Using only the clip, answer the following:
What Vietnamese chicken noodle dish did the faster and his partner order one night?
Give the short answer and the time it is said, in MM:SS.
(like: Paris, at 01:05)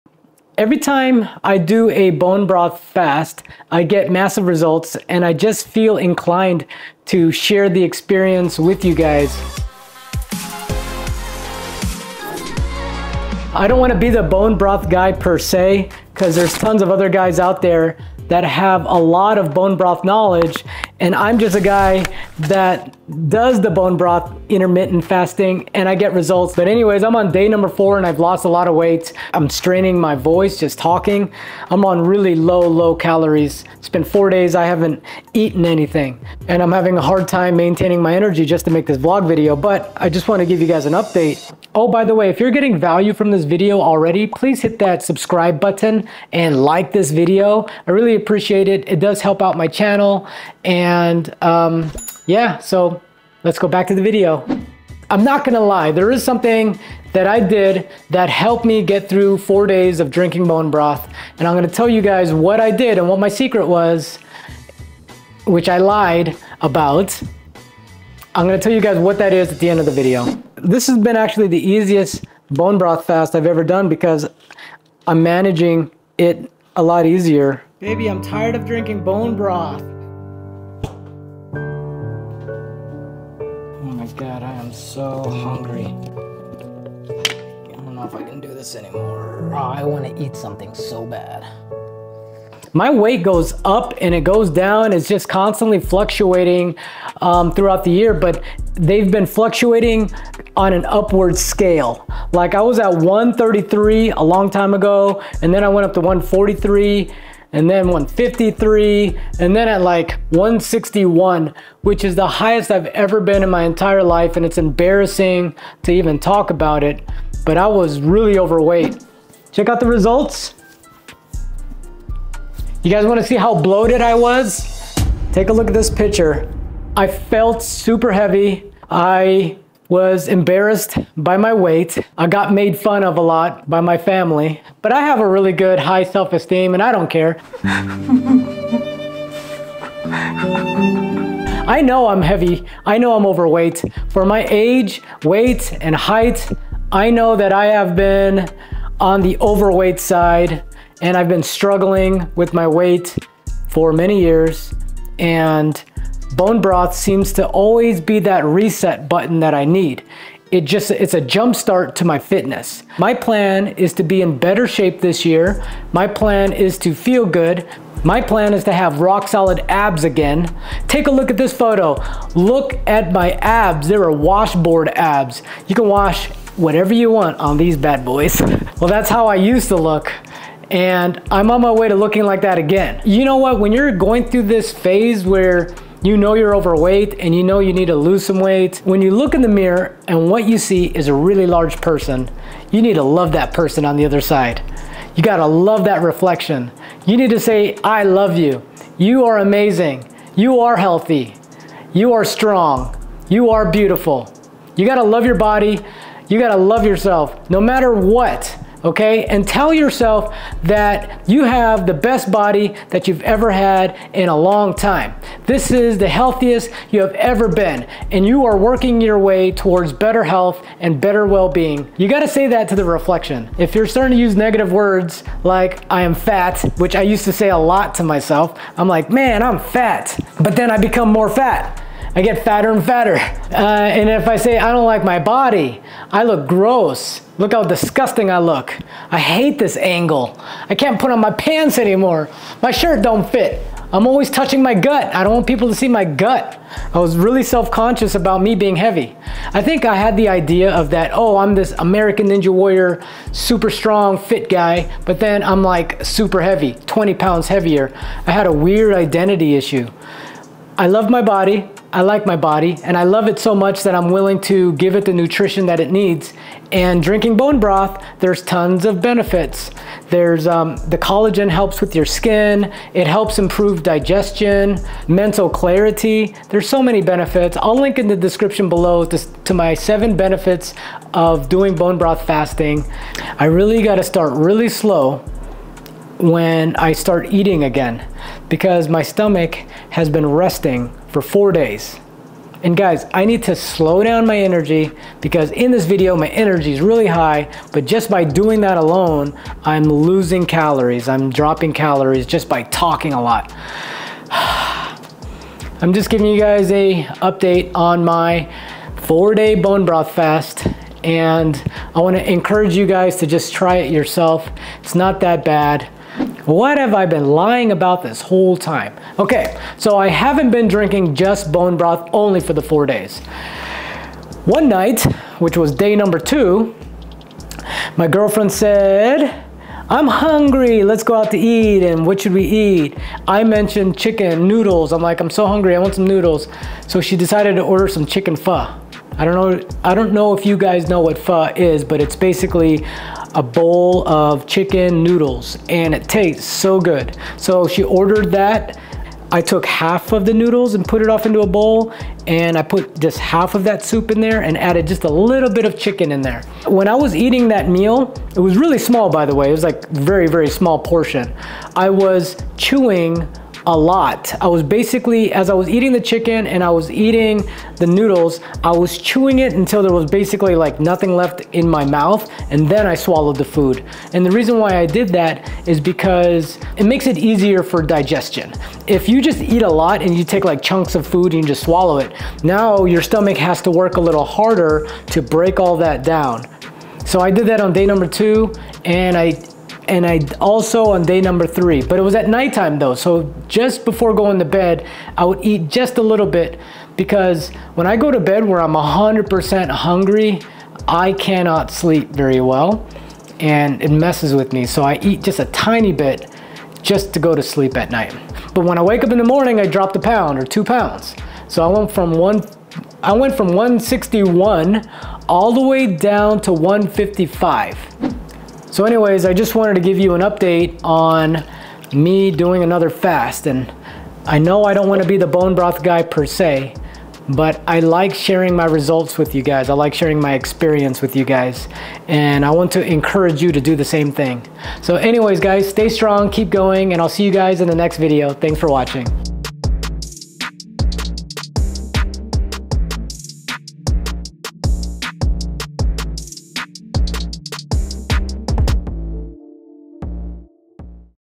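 chicken pho, at 05:38.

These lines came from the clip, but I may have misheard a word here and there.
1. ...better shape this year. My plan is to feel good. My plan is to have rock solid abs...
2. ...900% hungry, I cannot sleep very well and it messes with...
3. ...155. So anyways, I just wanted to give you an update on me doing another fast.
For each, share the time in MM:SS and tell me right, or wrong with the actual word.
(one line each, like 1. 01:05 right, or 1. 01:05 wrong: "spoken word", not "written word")
1. 02:44 right
2. 06:38 wrong: "100", not "900"
3. 06:56 right.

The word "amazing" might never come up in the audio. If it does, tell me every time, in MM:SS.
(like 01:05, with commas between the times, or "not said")
03:19.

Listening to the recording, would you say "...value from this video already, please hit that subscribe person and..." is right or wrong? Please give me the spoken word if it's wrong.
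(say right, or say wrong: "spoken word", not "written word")
wrong: "button", not "person".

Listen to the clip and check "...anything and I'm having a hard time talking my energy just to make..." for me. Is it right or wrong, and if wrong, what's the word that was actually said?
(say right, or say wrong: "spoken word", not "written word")
wrong: "maintaining", not "talking".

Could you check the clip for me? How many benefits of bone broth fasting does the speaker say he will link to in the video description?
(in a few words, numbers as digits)
7.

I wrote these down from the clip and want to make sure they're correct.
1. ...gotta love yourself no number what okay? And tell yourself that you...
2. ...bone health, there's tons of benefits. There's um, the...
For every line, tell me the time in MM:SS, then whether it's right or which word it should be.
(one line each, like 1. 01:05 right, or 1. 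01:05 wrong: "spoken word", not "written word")
1. 03:26 wrong: "matter", not "number"
2. 04:27 wrong: "broth", not "health".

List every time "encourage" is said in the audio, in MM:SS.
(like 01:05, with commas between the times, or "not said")
05:12, 07:12.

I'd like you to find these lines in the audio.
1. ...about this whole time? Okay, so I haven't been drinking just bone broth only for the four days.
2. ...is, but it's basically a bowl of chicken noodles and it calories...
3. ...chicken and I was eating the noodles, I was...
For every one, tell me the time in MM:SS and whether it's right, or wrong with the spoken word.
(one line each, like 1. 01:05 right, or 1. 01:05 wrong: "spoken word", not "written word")
1. 05:17 right
2. 05:41 wrong: "tastes", not "calories"
3. 06:06 right.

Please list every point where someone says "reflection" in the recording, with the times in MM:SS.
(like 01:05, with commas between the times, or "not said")
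03:16, 03:42.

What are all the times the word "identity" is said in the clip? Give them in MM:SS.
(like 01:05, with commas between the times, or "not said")
04:18.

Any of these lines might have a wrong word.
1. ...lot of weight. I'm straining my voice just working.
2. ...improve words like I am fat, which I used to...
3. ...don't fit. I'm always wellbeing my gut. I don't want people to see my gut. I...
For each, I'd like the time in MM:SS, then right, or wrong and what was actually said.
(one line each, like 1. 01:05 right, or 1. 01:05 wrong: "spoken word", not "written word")
1. 00:28 wrong: "talking", not "working"
2. 03:44 wrong: "negative", not "improve"
3. 04:03 wrong: "touching", not "wellbeing".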